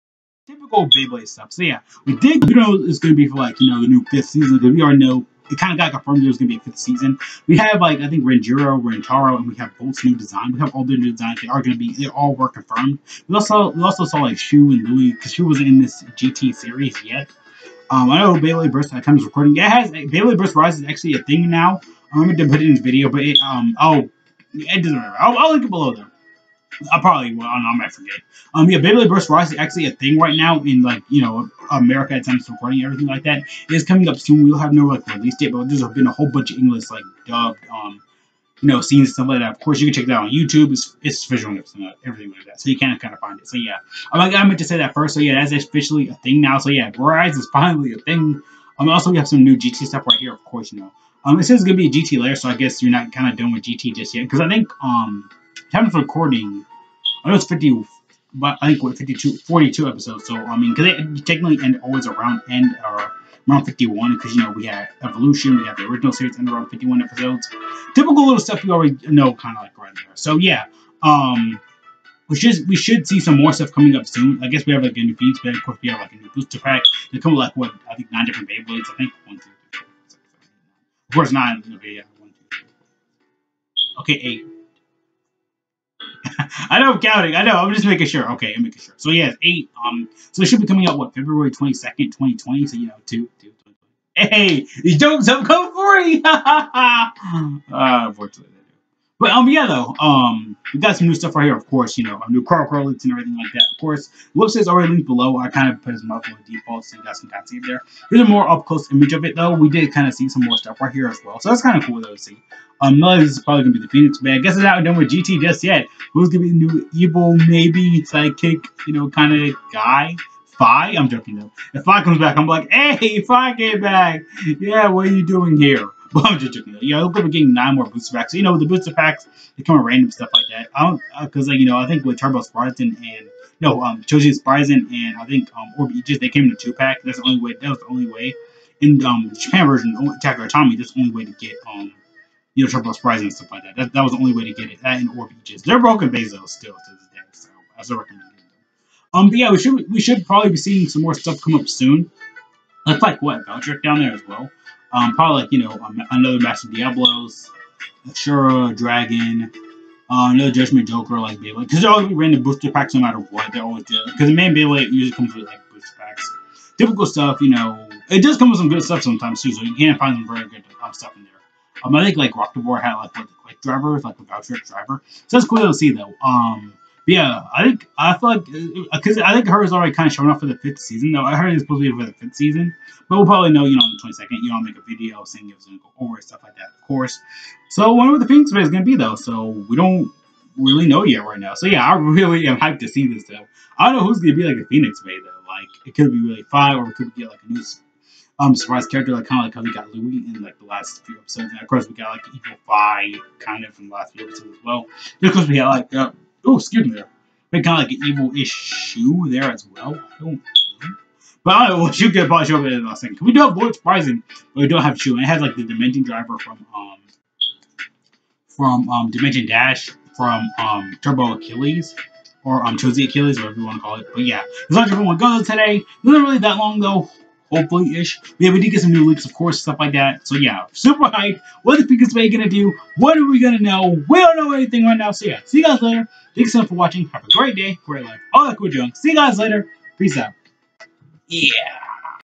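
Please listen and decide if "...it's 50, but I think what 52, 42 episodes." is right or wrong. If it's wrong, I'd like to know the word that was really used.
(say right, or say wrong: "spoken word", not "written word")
right.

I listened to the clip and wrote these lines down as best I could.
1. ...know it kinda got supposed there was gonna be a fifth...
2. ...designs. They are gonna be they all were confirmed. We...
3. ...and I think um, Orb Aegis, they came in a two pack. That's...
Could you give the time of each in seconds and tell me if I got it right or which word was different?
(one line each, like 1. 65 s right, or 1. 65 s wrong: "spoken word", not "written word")
1. 4 s wrong: "confirmed", not "supposed"
2. 11 s right
3. 134 s right.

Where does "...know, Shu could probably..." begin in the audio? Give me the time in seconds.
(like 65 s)
211 s.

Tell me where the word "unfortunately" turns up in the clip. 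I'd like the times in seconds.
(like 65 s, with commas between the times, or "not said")
97 s.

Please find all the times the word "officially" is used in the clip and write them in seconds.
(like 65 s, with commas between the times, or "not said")
45 s.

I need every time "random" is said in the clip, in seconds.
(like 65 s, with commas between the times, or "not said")
129 s, 162 s.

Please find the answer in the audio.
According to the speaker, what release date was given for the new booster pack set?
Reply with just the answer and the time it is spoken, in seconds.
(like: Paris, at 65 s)
February 22, 2020, at 91 s.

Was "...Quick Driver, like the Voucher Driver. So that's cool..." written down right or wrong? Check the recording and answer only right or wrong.
right.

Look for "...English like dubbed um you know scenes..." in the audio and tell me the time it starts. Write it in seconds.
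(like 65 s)
36 s.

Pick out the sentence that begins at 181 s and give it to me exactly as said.
Though I heard it's supposed to be for the fifth season, but we'll probably know, you know, on the twenty second.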